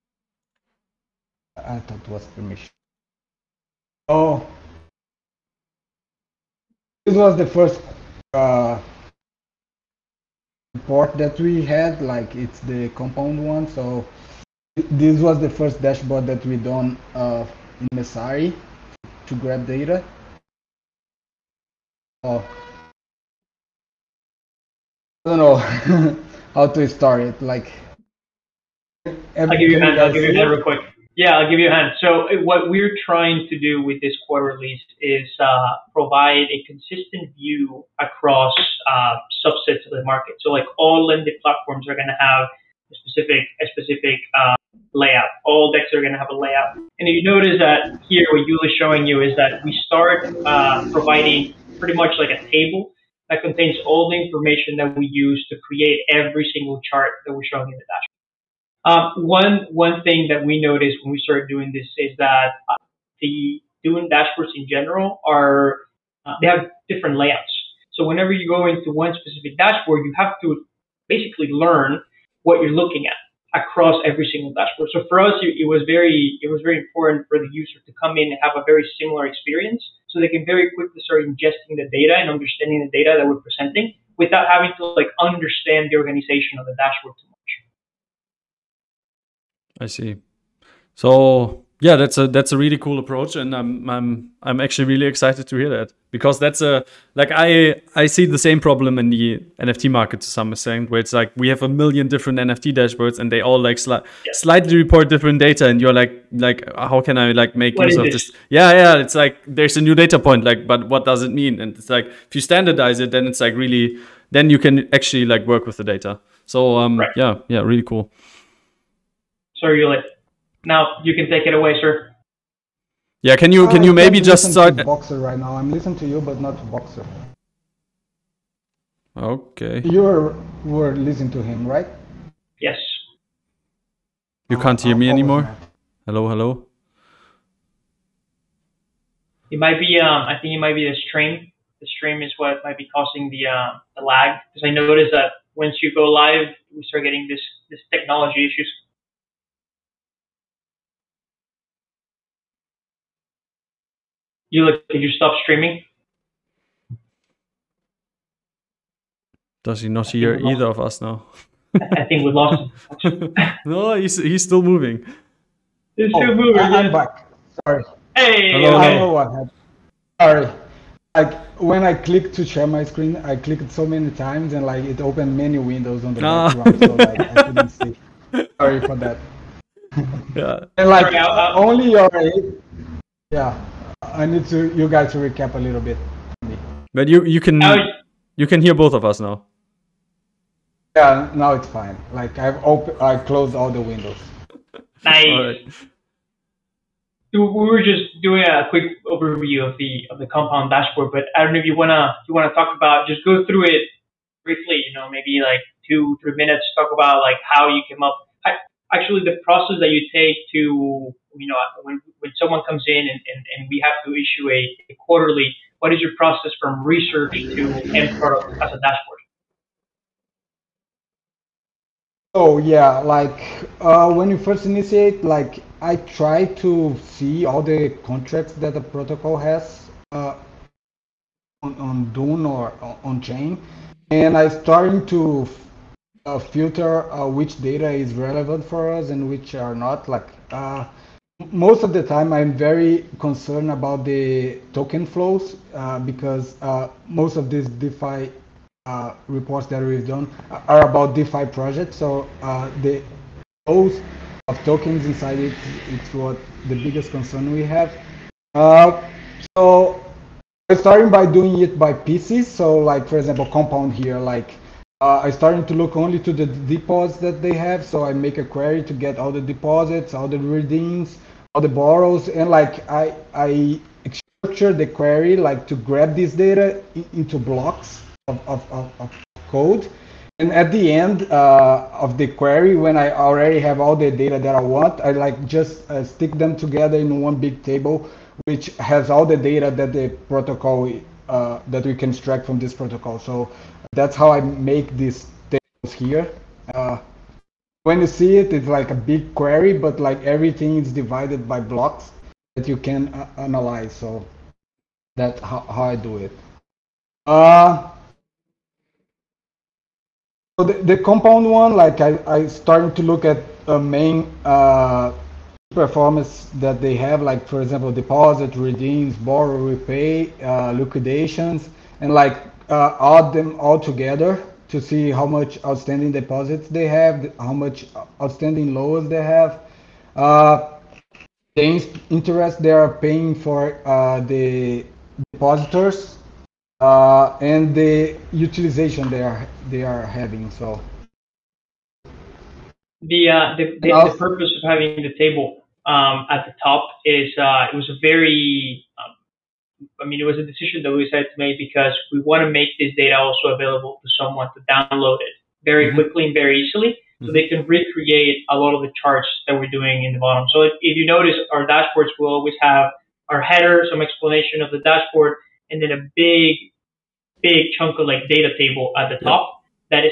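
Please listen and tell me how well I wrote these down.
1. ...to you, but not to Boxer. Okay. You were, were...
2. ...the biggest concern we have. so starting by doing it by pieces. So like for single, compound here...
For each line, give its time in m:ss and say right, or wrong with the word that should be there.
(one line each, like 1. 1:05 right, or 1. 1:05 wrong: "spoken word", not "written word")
1. 2:05 right
2. 4:16 wrong: "example", not "single".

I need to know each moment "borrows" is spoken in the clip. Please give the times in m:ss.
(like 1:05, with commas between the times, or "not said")
4:31, 5:19.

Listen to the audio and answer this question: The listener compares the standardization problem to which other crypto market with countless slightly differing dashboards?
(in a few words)
NFT market.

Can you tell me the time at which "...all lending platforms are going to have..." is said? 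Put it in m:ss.
0:40.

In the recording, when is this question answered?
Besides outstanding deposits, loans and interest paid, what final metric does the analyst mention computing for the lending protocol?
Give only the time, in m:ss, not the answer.
5:38.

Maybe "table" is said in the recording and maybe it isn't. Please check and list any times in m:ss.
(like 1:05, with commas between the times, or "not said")
0:52, 4:47, 4:55, 5:45, 6:08.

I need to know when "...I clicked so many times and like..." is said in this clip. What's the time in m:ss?
2:53.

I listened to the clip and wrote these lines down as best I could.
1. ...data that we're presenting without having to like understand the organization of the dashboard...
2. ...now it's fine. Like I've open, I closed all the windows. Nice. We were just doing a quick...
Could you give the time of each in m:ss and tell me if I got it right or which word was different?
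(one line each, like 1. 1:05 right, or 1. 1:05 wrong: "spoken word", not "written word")
1. 1:22 right
2. 3:11 right.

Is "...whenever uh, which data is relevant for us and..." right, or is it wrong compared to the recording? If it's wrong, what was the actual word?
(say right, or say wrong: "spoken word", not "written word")
wrong: "filter", not "whenever".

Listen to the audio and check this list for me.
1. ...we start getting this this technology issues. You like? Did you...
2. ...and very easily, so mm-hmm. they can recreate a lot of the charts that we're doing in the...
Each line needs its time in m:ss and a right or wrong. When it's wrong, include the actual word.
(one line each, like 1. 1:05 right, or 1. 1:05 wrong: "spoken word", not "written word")
1. 2:26 right
2. 5:56 right.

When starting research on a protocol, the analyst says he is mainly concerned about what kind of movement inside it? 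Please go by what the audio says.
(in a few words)
Token flows.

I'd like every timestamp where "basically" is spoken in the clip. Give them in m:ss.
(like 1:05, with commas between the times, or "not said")
1:11.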